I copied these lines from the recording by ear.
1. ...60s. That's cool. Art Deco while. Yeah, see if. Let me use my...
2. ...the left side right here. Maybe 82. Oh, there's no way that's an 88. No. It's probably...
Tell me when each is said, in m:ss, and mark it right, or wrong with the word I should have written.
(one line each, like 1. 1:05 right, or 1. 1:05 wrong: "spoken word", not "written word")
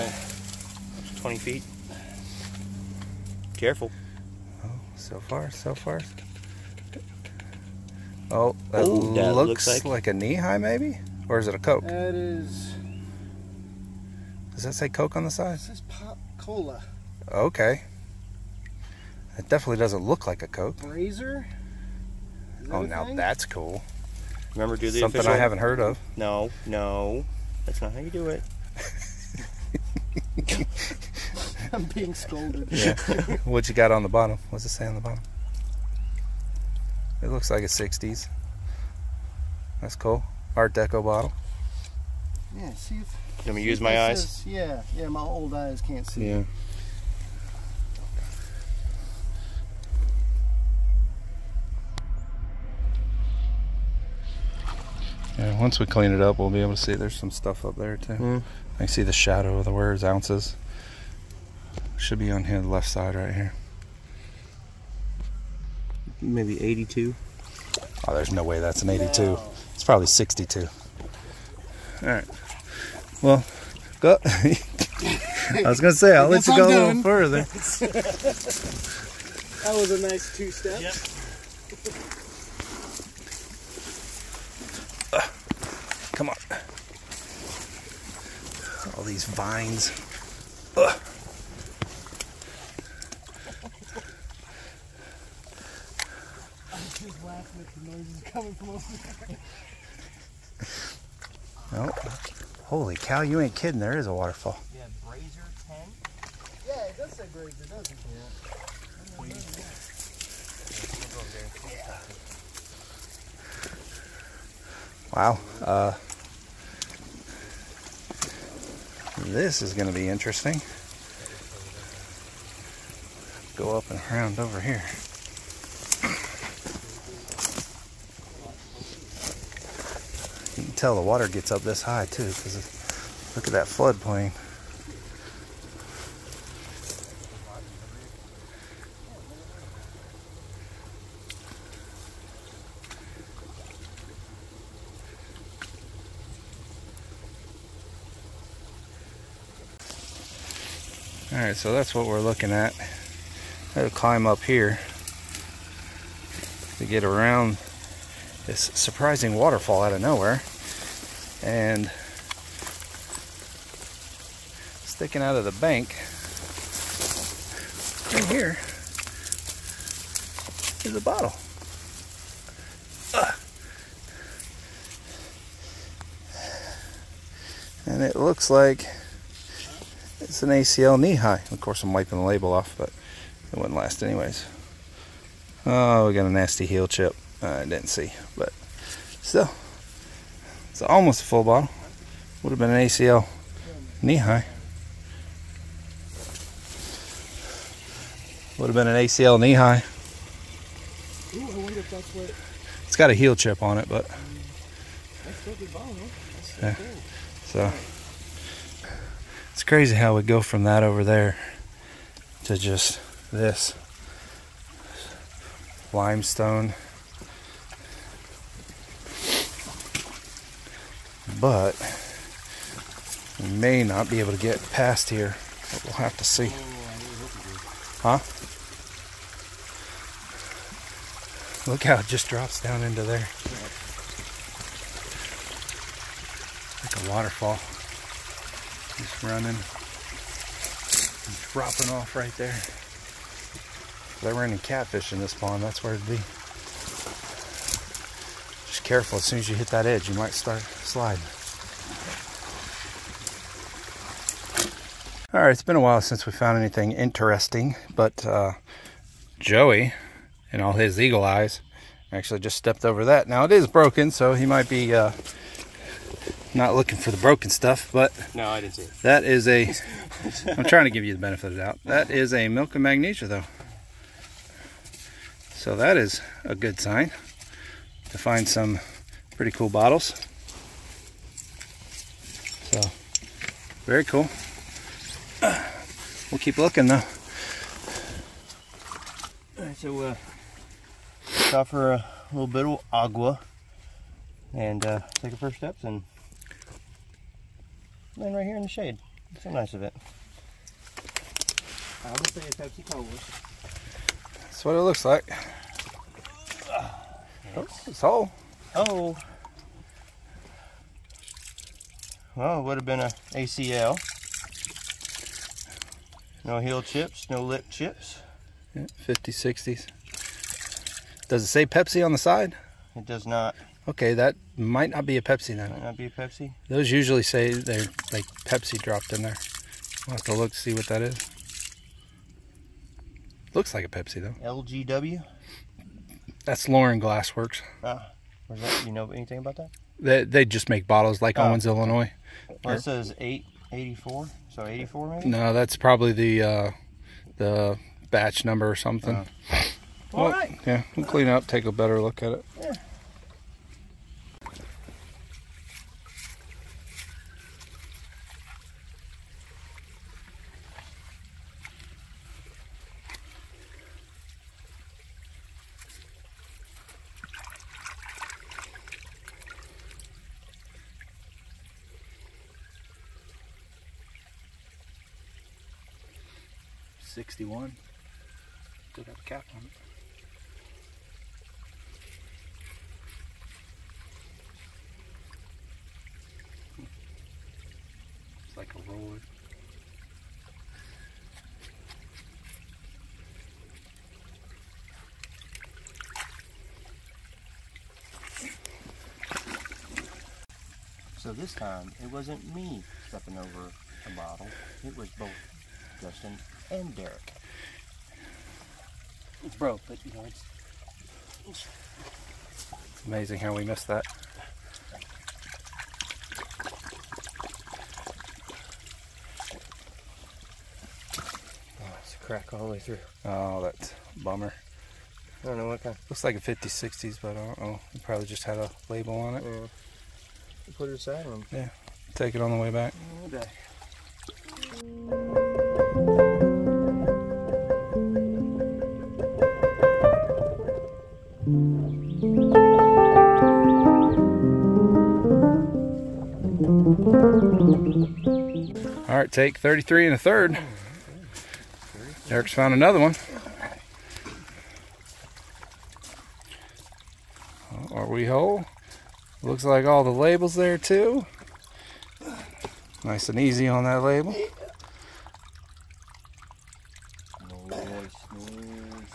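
1. 0:37 wrong: "bottle", not "while"
2. 1:02 wrong: "82", not "88".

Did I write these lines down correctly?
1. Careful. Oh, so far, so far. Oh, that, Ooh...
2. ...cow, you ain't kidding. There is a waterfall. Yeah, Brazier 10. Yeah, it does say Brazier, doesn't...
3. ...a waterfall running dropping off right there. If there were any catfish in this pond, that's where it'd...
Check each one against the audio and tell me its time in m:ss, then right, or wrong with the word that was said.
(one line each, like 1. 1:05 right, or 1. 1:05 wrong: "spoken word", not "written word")
1. 0:03 right
2. 1:42 right
3. 3:57 right.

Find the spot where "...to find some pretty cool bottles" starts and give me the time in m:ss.
4:38.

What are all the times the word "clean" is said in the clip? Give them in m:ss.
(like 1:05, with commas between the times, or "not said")
0:55, 5:51.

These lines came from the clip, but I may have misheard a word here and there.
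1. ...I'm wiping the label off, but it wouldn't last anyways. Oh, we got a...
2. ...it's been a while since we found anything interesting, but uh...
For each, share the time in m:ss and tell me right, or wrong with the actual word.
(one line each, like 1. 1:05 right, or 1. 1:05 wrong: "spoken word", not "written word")
1. 3:01 right
2. 4:15 right.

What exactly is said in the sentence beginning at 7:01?
Oh, it's a crack all the way through.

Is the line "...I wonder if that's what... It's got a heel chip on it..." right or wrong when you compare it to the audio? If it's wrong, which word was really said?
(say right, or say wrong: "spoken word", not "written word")
right.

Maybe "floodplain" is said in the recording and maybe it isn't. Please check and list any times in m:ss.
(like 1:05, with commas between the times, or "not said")
2:13.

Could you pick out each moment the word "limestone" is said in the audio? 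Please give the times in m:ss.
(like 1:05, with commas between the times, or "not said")
3:35.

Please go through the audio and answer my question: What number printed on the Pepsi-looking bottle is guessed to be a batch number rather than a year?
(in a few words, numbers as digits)
884.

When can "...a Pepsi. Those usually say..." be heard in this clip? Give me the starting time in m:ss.
5:26.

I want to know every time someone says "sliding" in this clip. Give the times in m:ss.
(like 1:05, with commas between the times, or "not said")
4:10.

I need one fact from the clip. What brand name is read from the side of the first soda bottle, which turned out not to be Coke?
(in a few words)
Pop Cola.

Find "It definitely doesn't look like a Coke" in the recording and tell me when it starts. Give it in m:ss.
0:19.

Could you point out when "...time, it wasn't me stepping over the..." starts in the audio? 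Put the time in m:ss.
6:41.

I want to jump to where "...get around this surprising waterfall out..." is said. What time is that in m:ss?
2:36.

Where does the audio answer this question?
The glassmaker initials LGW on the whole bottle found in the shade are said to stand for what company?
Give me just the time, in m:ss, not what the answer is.
5:36.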